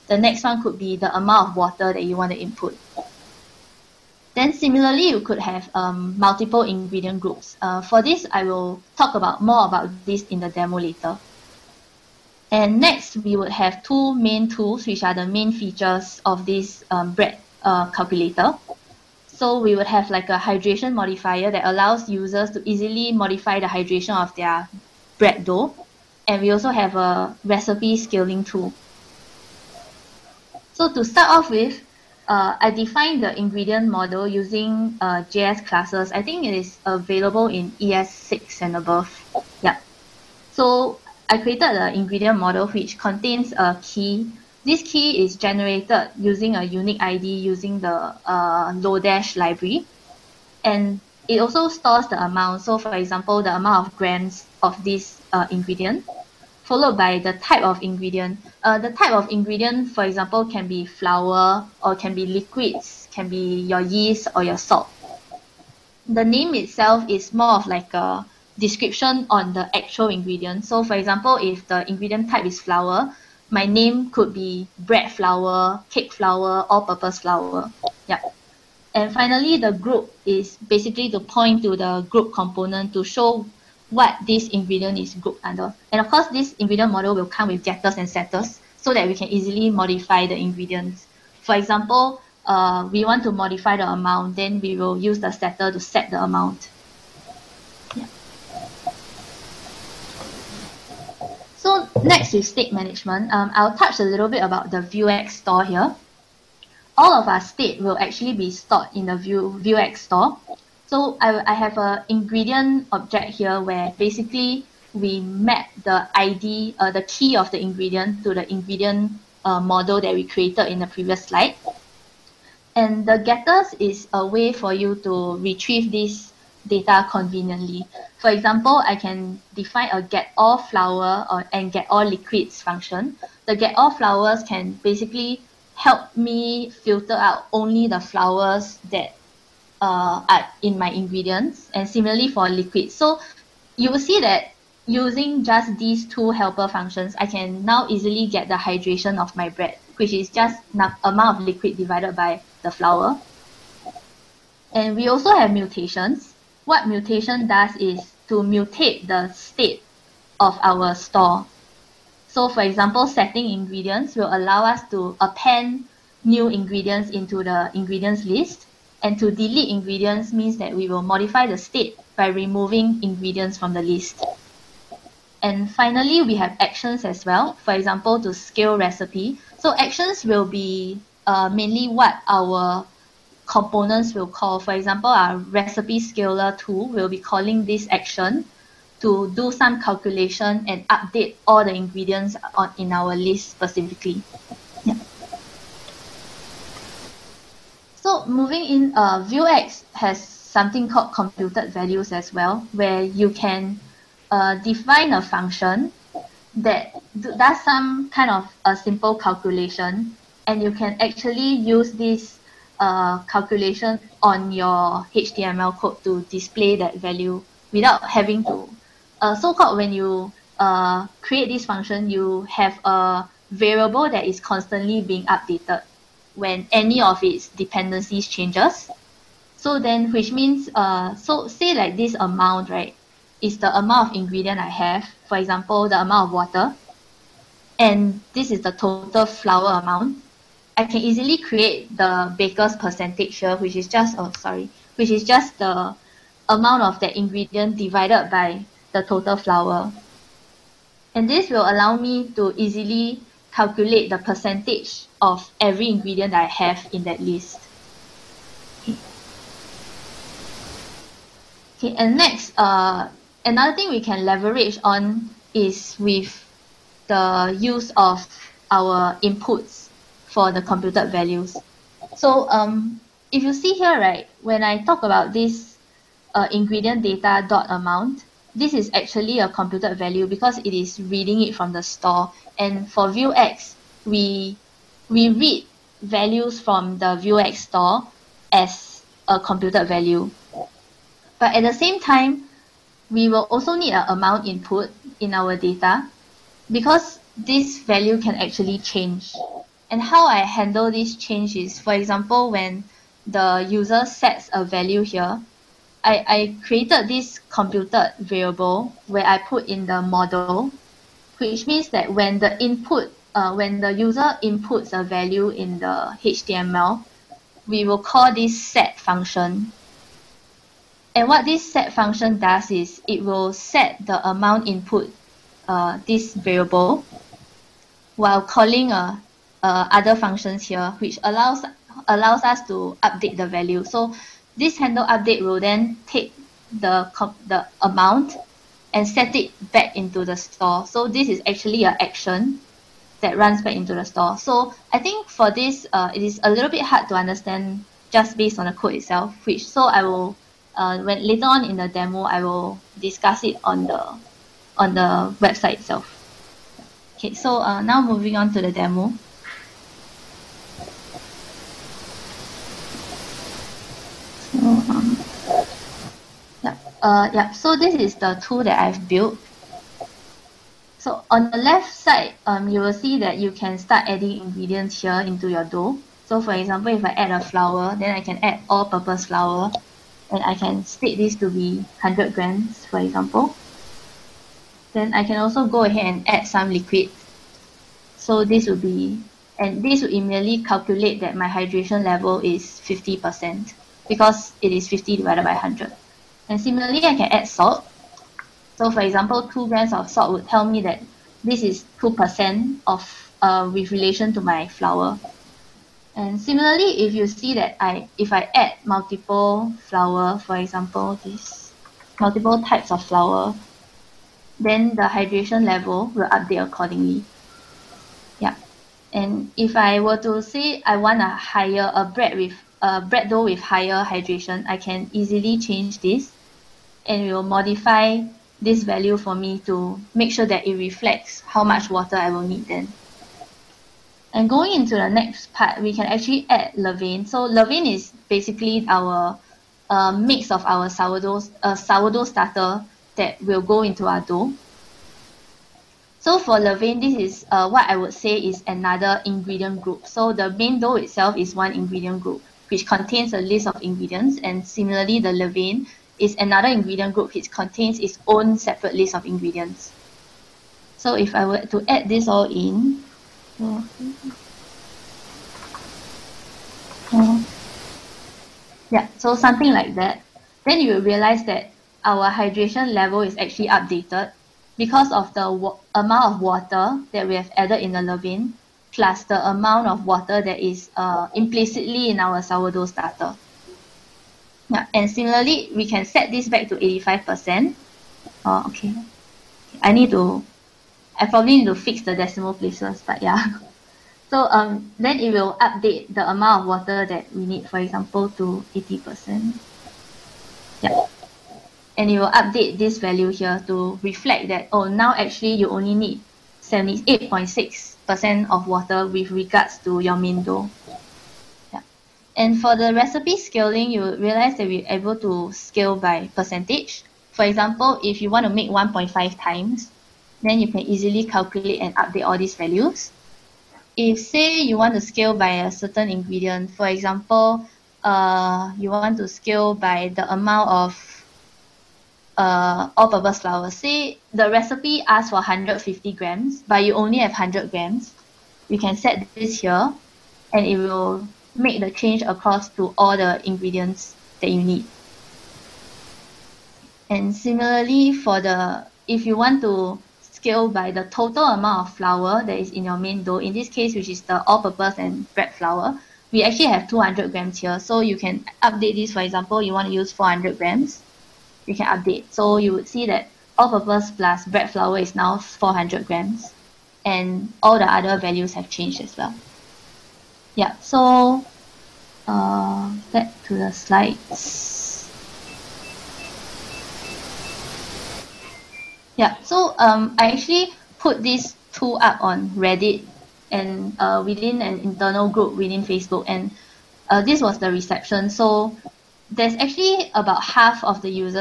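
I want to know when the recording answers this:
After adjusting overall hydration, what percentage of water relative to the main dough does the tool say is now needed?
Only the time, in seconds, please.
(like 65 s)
506 s.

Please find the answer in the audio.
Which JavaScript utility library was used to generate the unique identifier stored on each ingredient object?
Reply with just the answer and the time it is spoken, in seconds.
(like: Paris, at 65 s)
Lodash, at 48 s.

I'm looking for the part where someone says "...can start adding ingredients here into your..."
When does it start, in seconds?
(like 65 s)
373 s.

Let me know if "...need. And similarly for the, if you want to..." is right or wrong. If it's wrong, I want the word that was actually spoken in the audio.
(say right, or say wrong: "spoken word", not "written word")
right.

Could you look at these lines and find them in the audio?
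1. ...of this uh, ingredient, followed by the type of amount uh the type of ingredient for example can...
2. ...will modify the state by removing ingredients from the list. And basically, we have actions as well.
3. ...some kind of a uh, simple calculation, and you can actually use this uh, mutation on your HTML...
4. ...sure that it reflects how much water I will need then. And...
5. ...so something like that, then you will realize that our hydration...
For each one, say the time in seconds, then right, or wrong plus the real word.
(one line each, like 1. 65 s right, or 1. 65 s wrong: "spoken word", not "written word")
1. 54 s wrong: "ingredient", not "amount"
2. 170 s wrong: "finally", not "basically"
3. 207 s wrong: "calculation", not "mutation"
4. 430 s right
5. 469 s right.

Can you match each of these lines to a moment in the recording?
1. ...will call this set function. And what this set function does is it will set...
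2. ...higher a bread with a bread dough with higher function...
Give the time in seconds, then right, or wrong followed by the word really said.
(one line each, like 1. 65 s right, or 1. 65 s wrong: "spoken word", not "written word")
1. 317 s right
2. 421 s wrong: "hydration", not "function".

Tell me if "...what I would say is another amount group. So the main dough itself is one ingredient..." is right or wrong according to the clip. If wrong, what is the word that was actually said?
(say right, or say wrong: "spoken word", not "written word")
wrong: "ingredient", not "amount".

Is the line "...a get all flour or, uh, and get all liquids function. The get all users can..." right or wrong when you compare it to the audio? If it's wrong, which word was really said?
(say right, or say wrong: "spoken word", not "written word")
wrong: "flours", not "users".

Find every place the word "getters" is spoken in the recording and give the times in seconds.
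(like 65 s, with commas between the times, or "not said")
87 s, 123 s.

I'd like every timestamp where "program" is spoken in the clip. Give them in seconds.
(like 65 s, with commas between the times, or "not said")
not said.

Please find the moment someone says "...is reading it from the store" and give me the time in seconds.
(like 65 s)
280 s.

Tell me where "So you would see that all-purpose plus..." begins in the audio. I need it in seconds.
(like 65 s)
562 s.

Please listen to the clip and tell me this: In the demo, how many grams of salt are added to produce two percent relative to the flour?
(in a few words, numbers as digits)
2 grams.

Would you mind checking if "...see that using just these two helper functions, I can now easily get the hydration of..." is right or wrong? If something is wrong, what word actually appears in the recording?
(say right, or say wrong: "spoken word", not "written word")
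right.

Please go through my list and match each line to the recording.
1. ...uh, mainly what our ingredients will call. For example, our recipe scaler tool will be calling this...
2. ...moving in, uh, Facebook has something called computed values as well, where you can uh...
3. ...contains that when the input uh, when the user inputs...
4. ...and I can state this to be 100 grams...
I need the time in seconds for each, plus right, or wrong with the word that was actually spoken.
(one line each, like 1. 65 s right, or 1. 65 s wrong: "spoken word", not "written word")
1. 181 s wrong: "components", not "ingredients"
2. 198 s wrong: "Vuex", not "Facebook"
3. 311 s wrong: "means", not "contains"
4. 380 s right.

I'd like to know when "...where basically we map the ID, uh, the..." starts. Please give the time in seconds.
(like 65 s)
113 s.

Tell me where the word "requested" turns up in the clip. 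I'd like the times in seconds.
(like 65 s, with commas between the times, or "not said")
not said.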